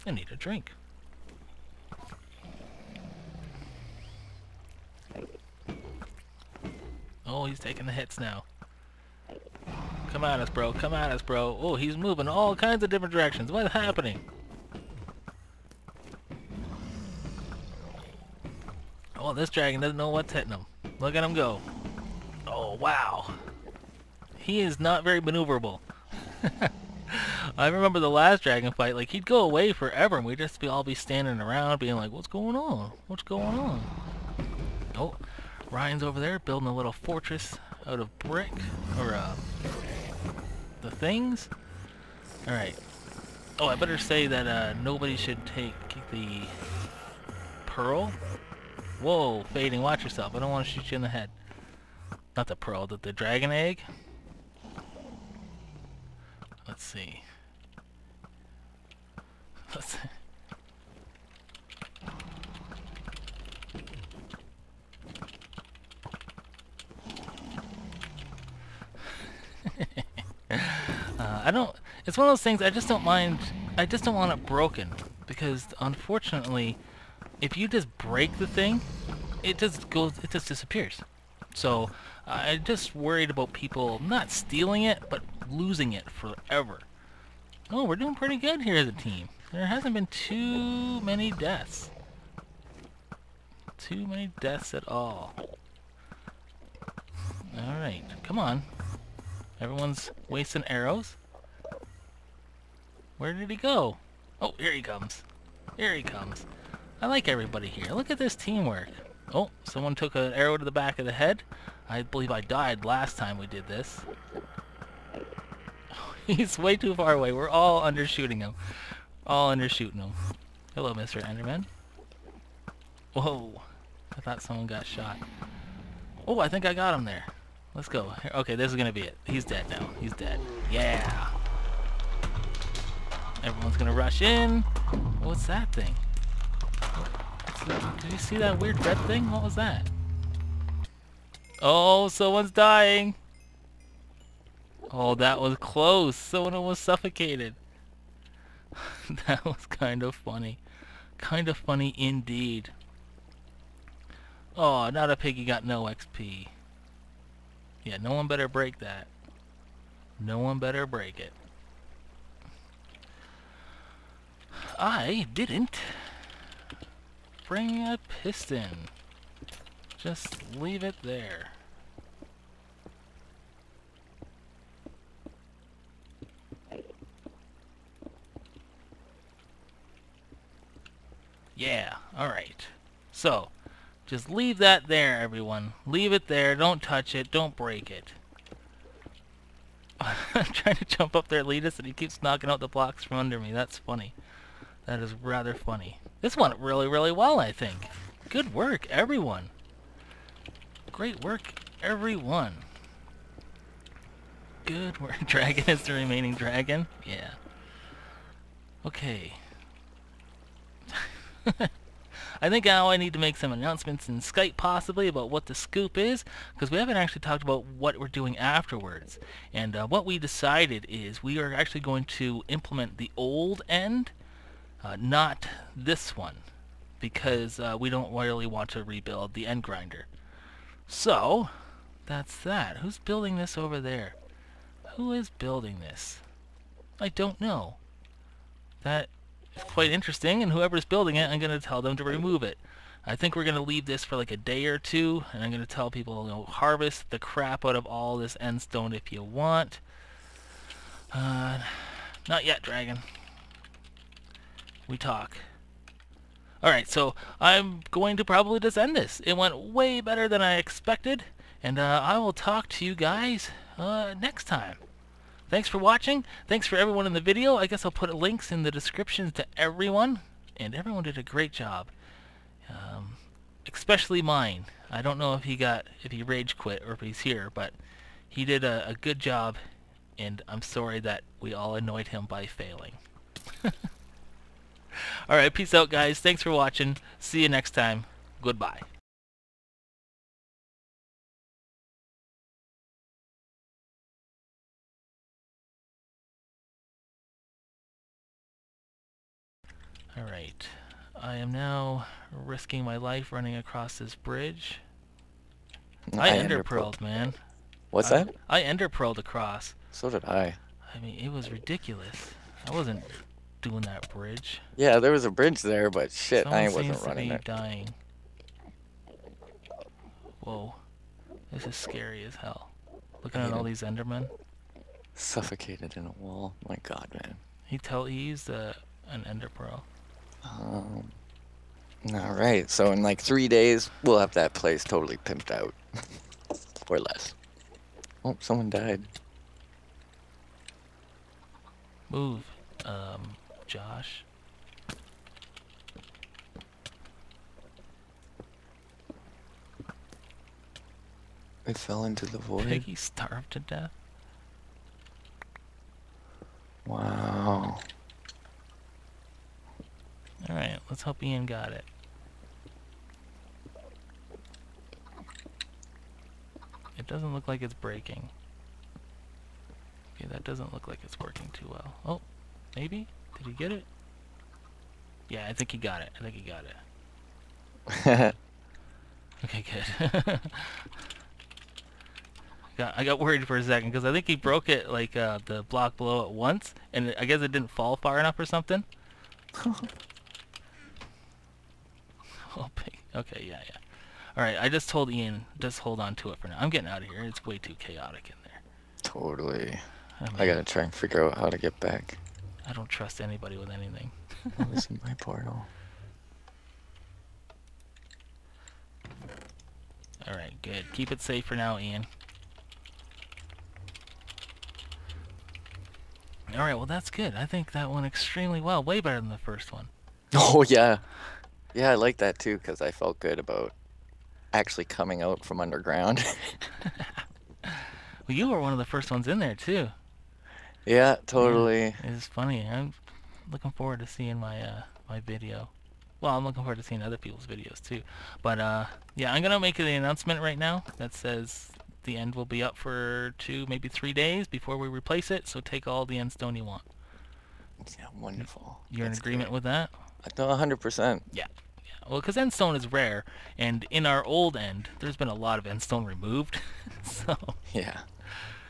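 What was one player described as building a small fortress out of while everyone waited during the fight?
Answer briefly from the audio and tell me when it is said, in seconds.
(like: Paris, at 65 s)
Brick, at 38 s.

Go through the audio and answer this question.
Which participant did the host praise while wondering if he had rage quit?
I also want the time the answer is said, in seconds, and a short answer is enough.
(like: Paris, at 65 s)
Myne, at 274 s.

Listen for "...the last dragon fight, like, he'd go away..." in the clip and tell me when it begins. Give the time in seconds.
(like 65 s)
27 s.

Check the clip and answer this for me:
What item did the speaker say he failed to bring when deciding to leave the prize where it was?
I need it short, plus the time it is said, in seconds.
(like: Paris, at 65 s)
A piston, at 168 s.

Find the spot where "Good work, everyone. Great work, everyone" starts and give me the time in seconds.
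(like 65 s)
198 s.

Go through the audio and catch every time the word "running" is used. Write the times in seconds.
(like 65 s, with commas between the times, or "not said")
303 s, 317 s.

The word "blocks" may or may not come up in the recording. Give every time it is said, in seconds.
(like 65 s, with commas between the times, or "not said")
192 s, 385 s.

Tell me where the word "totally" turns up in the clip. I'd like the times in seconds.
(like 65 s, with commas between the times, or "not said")
334 s, 399 s, 431 s.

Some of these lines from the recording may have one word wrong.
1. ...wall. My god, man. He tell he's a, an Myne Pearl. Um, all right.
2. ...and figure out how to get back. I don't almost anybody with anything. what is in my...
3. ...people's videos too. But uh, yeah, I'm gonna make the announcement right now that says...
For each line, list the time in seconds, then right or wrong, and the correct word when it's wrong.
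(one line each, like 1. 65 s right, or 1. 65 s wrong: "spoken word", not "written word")
1. 326 s wrong: "Ender", not "Myne"
2. 400 s wrong: "trust", not "almost"
3. 437 s right.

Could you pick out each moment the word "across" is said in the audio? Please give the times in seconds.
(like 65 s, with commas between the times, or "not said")
303 s, 309 s.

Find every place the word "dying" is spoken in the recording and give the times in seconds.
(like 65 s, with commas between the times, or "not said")
142 s, 317 s.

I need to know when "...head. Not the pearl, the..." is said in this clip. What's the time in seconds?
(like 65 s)
51 s.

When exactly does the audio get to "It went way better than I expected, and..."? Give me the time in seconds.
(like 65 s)
259 s.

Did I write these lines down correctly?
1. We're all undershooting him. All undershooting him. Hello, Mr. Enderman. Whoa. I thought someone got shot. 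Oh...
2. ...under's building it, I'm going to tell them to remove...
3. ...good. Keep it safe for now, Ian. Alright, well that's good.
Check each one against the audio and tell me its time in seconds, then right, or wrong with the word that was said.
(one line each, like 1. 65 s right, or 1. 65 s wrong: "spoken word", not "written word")
1. 117 s right
2. 240 s wrong: "whoever", not "under"
3. 410 s right.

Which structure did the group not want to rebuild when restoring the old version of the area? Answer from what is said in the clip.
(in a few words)
The end grinder.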